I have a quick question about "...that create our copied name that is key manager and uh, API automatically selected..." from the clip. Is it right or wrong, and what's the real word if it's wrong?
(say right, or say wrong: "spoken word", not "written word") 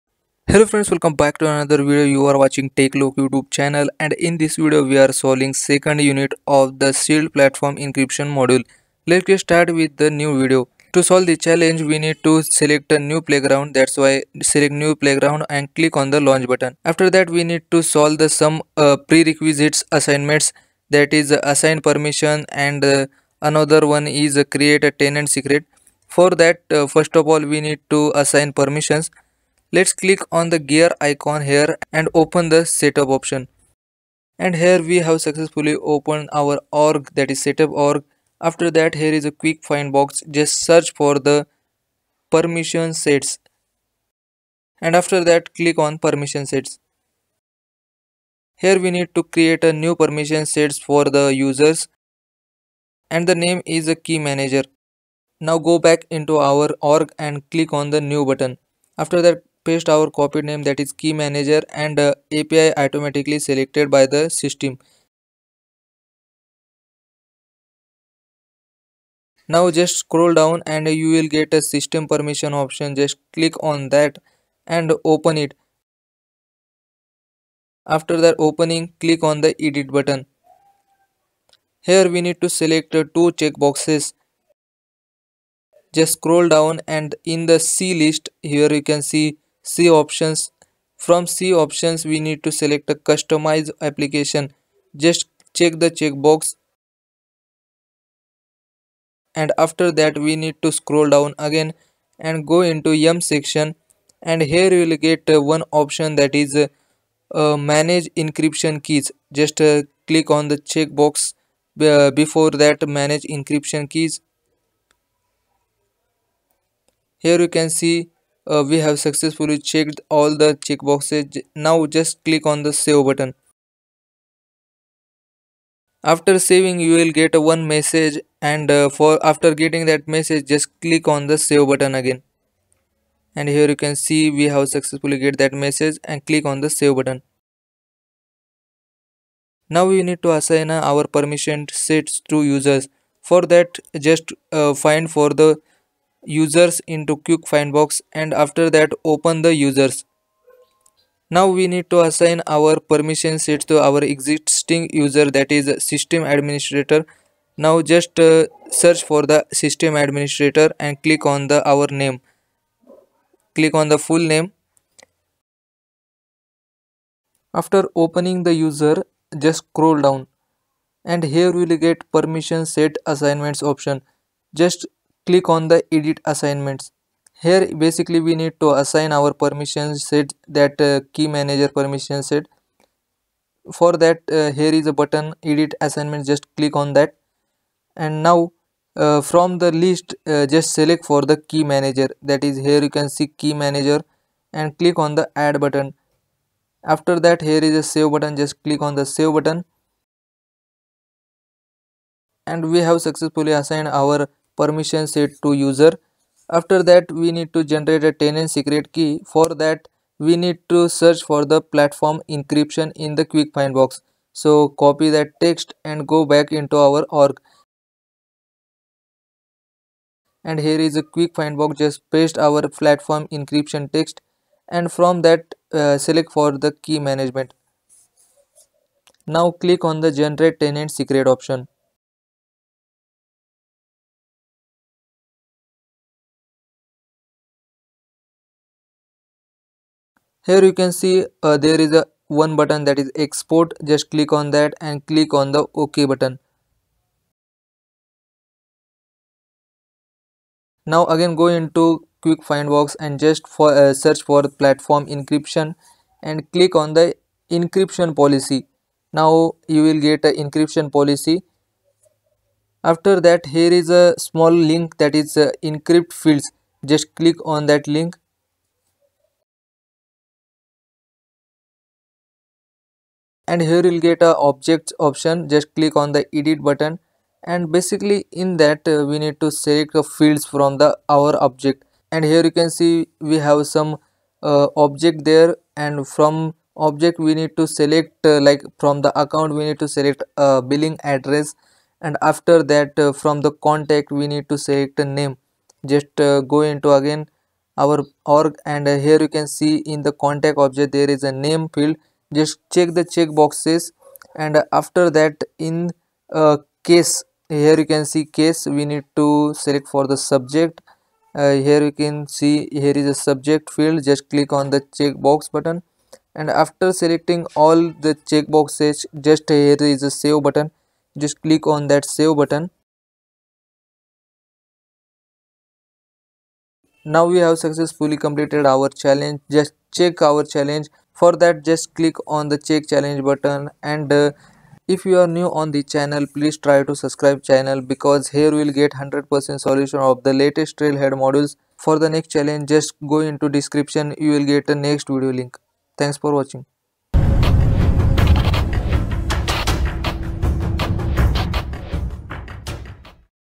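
wrong: "paste", not "create".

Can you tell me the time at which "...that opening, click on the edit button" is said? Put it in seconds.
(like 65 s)
78 s.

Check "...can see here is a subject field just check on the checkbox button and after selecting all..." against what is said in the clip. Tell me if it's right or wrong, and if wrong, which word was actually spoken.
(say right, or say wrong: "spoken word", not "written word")
wrong: "click", not "check".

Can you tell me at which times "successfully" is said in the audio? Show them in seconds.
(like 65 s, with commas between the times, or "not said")
35 s, 118 s, 134 s, 202 s, 327 s.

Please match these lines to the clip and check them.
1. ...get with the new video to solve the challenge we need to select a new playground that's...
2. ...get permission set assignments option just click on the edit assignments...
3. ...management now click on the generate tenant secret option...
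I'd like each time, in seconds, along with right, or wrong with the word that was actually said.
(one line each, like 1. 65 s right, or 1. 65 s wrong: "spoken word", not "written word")
1. 9 s right
2. 171 s right
3. 226 s right.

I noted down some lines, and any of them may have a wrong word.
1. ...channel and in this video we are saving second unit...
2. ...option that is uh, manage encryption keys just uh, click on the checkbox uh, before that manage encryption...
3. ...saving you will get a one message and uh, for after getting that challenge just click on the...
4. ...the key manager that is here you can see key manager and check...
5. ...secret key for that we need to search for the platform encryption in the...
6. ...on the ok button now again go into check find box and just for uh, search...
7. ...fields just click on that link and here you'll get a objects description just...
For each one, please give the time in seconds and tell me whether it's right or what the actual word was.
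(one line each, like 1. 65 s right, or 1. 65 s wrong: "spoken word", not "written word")
1. 3 s wrong: "solving", not "saving"
2. 105 s right
3. 126 s wrong: "message", not "challenge"
4. 191 s wrong: "click", not "check"
5. 208 s right
6. 245 s wrong: "quick", not "check"
7. 266 s wrong: "option", not "description".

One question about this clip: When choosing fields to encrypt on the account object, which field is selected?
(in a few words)
Billing address.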